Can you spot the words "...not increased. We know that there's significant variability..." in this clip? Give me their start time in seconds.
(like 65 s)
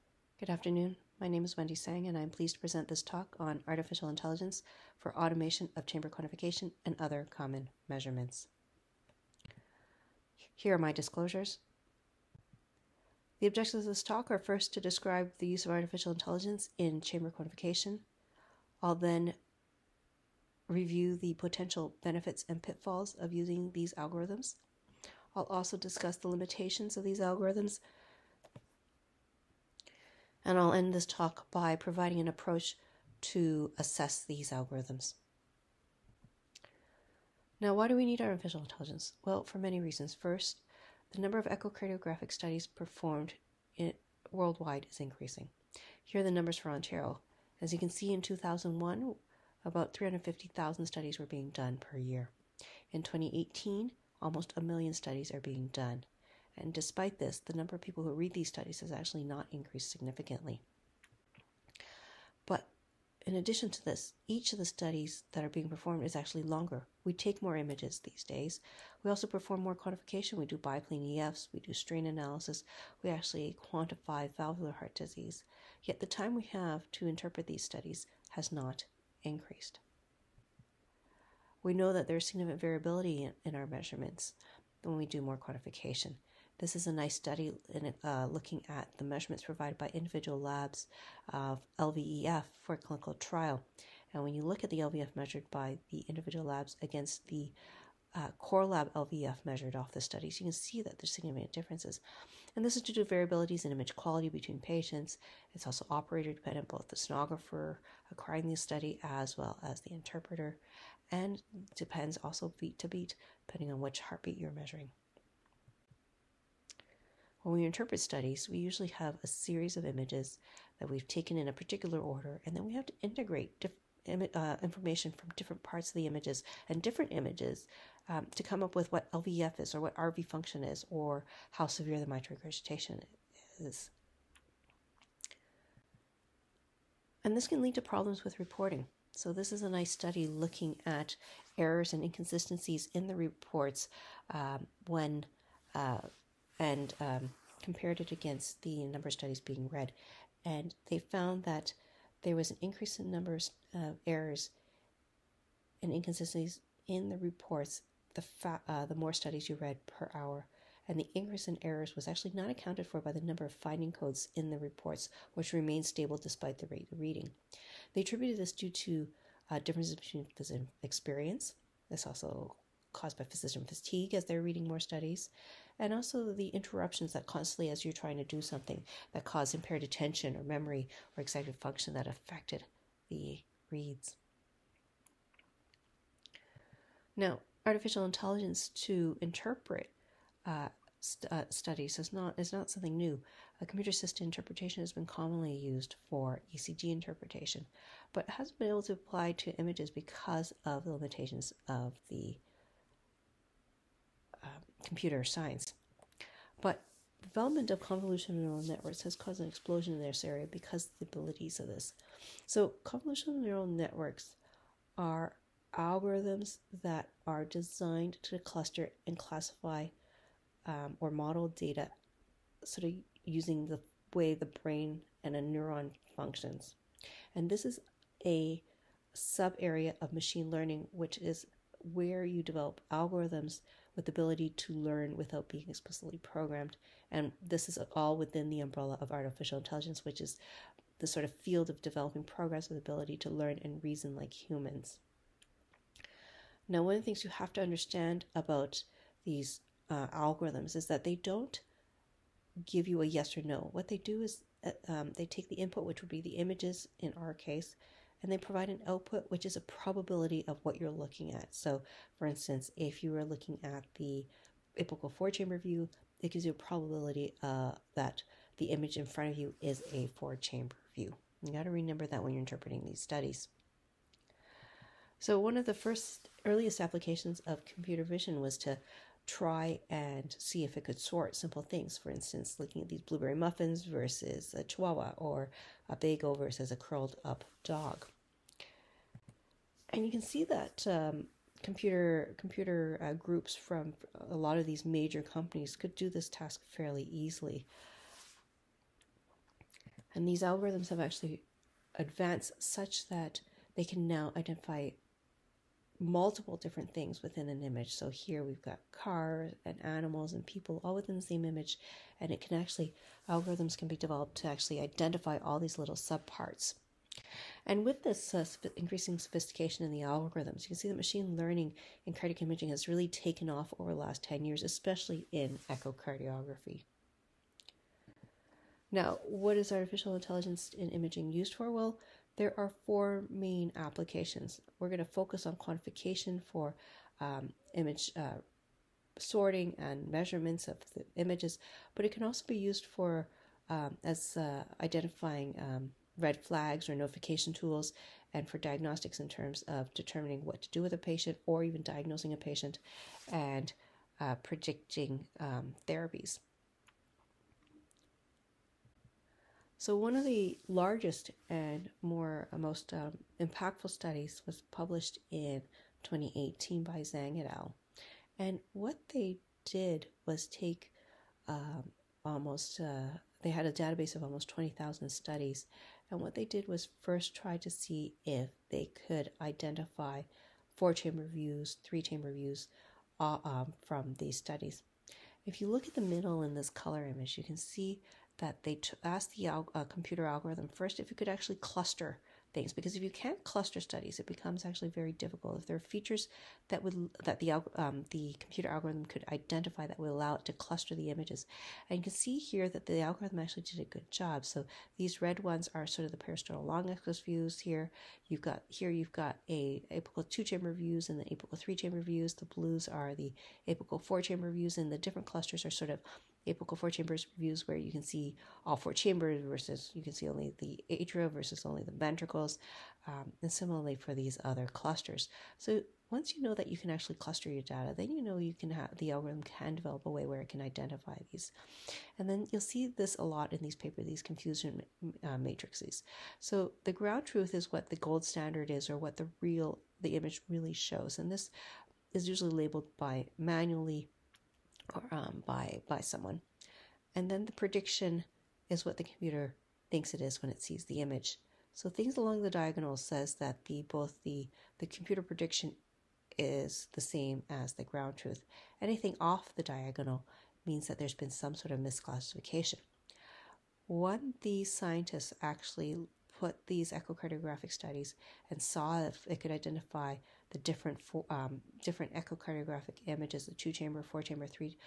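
78 s.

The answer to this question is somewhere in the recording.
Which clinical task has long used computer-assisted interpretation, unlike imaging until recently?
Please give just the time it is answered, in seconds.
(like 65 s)
196 s.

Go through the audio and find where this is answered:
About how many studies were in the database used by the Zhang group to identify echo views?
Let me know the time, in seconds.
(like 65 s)
374 s.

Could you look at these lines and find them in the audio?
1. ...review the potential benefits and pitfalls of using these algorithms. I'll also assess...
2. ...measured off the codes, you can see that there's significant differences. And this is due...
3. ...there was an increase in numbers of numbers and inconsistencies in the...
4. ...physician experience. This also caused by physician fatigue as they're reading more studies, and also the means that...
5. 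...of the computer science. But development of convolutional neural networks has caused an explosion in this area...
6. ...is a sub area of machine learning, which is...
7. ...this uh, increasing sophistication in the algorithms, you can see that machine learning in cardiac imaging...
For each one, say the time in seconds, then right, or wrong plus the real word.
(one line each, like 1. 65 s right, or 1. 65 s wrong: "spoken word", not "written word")
1. 20 s wrong: "discuss", not "assess"
2. 99 s wrong: "studies", not "codes"
3. 152 s wrong: "errors", not "numbers"
4. 170 s wrong: "interruptions", not "means"
5. 201 s right
6. 227 s right
7. 318 s right.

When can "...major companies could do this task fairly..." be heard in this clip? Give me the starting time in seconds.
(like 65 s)
294 s.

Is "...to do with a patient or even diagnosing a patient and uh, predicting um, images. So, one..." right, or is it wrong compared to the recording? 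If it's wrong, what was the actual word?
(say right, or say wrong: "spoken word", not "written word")
wrong: "therapies", not "images".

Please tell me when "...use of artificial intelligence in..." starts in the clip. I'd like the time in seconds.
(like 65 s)
15 s.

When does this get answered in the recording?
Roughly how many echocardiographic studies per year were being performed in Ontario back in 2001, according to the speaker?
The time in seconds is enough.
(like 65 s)
49 s.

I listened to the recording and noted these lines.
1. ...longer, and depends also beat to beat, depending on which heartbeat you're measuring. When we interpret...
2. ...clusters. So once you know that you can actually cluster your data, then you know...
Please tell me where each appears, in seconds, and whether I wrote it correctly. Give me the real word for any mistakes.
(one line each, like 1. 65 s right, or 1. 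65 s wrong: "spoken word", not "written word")
1. 109 s wrong: "interpreter", not "longer"
2. 424 s right.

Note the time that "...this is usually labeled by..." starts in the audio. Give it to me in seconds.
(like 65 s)
441 s.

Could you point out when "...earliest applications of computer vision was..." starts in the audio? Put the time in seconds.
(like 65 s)
276 s.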